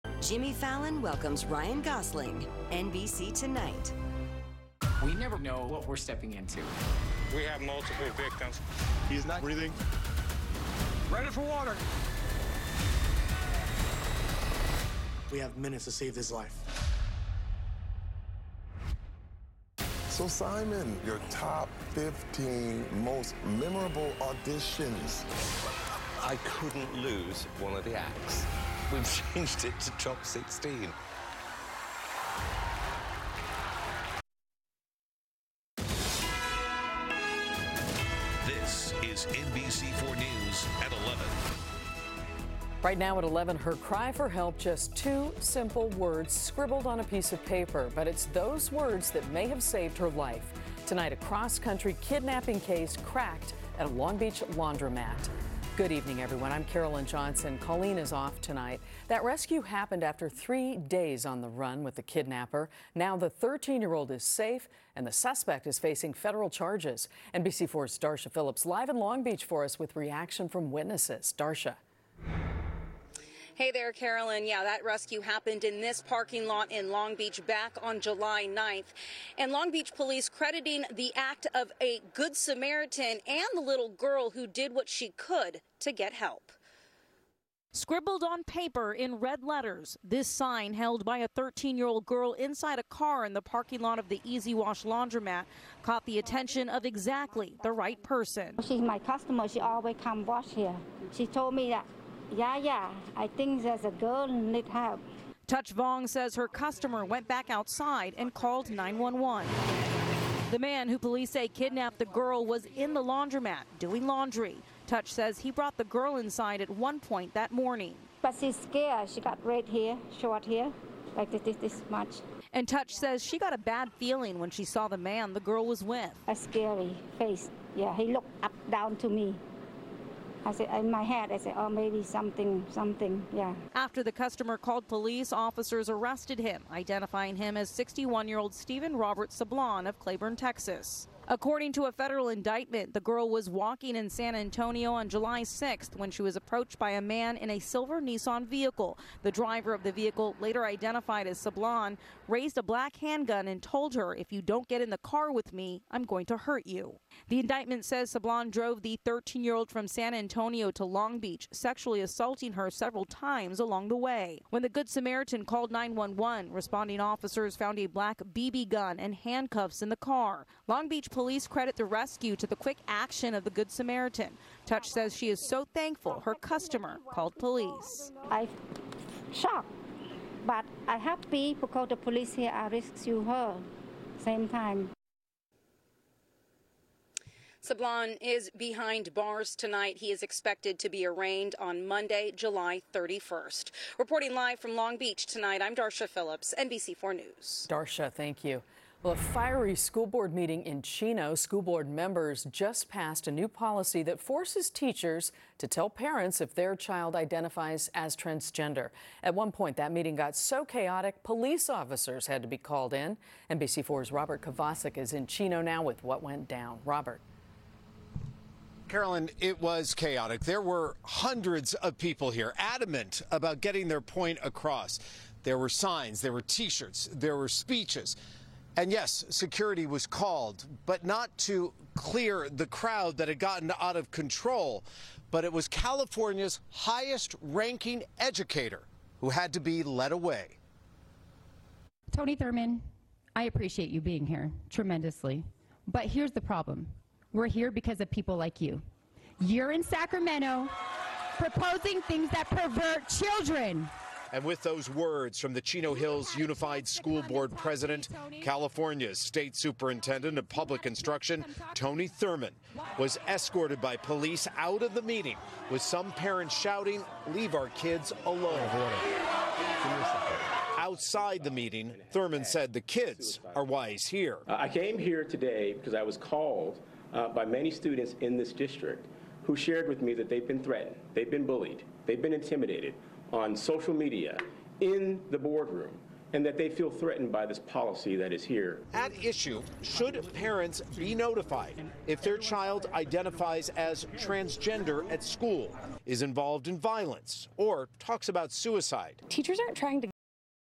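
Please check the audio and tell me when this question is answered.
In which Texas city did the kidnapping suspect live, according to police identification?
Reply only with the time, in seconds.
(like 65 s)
139 s.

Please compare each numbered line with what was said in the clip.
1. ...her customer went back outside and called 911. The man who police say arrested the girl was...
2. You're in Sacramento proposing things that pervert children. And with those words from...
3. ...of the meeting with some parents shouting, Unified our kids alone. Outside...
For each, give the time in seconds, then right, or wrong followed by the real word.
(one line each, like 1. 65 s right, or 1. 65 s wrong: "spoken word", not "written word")
1. 106 s wrong: "kidnapped", not "arrested"
2. 249 s right
3. 264 s wrong: "Leave", not "Unified".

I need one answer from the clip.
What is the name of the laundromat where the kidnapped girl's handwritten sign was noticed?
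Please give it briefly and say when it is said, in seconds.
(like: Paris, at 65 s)
Easy Wash, at 94 s.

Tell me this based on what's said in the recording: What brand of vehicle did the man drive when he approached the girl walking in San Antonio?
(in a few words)
Nissan.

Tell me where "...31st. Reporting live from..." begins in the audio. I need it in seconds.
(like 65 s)
192 s.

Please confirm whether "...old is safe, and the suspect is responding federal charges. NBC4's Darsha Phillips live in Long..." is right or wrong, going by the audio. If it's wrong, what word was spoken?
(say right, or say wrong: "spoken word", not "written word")
wrong: "facing", not "responding".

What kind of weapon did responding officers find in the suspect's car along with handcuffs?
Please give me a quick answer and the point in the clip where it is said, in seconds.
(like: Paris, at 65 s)
BB gun, at 168 s.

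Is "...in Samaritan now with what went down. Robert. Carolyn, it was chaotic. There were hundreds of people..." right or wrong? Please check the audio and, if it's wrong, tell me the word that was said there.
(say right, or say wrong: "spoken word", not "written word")
wrong: "Chino", not "Samaritan".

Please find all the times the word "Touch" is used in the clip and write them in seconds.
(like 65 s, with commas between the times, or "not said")
105 s, 114 s, 122 s, 174 s.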